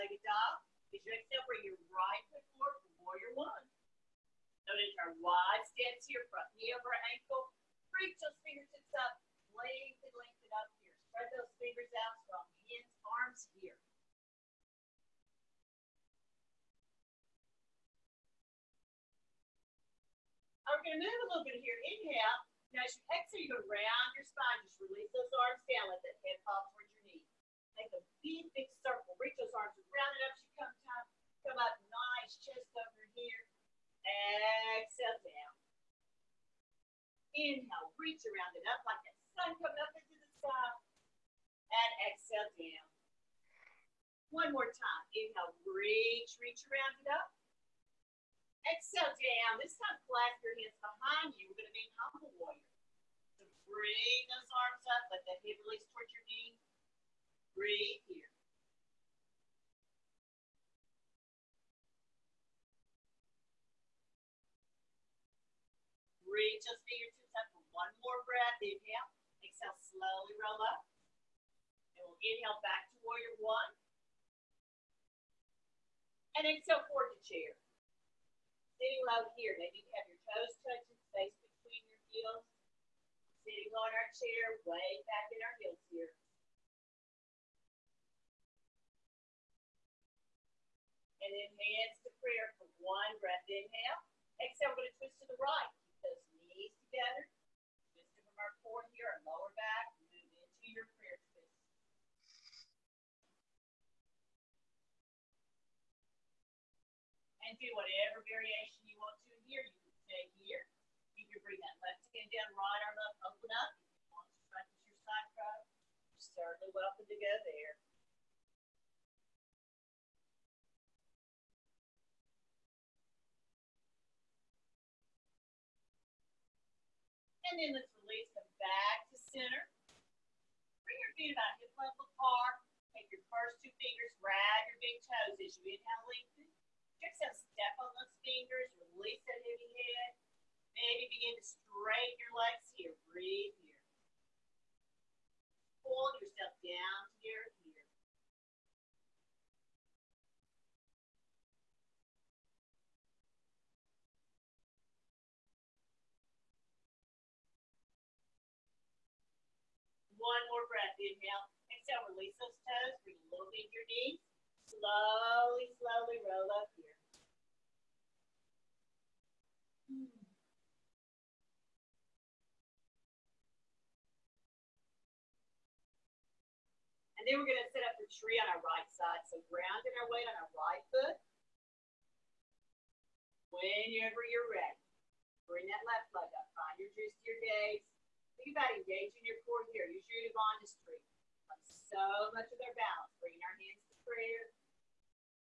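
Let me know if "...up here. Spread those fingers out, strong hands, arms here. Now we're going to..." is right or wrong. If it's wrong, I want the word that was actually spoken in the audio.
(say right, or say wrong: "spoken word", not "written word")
right.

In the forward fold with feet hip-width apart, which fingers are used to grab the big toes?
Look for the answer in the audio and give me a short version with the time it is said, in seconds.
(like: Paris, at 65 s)
first two fingers, at 133 s.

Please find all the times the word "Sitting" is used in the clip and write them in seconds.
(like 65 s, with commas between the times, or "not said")
78 s, 83 s.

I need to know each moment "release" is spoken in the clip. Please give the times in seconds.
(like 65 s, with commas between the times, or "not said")
24 s, 55 s, 127 s, 138 s, 162 s.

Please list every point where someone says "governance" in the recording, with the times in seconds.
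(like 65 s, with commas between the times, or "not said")
not said.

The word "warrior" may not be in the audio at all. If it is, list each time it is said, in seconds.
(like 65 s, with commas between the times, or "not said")
3 s, 52 s, 73 s.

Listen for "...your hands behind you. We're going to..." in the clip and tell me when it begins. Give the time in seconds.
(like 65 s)
50 s.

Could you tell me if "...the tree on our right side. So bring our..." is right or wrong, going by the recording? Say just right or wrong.
wrong.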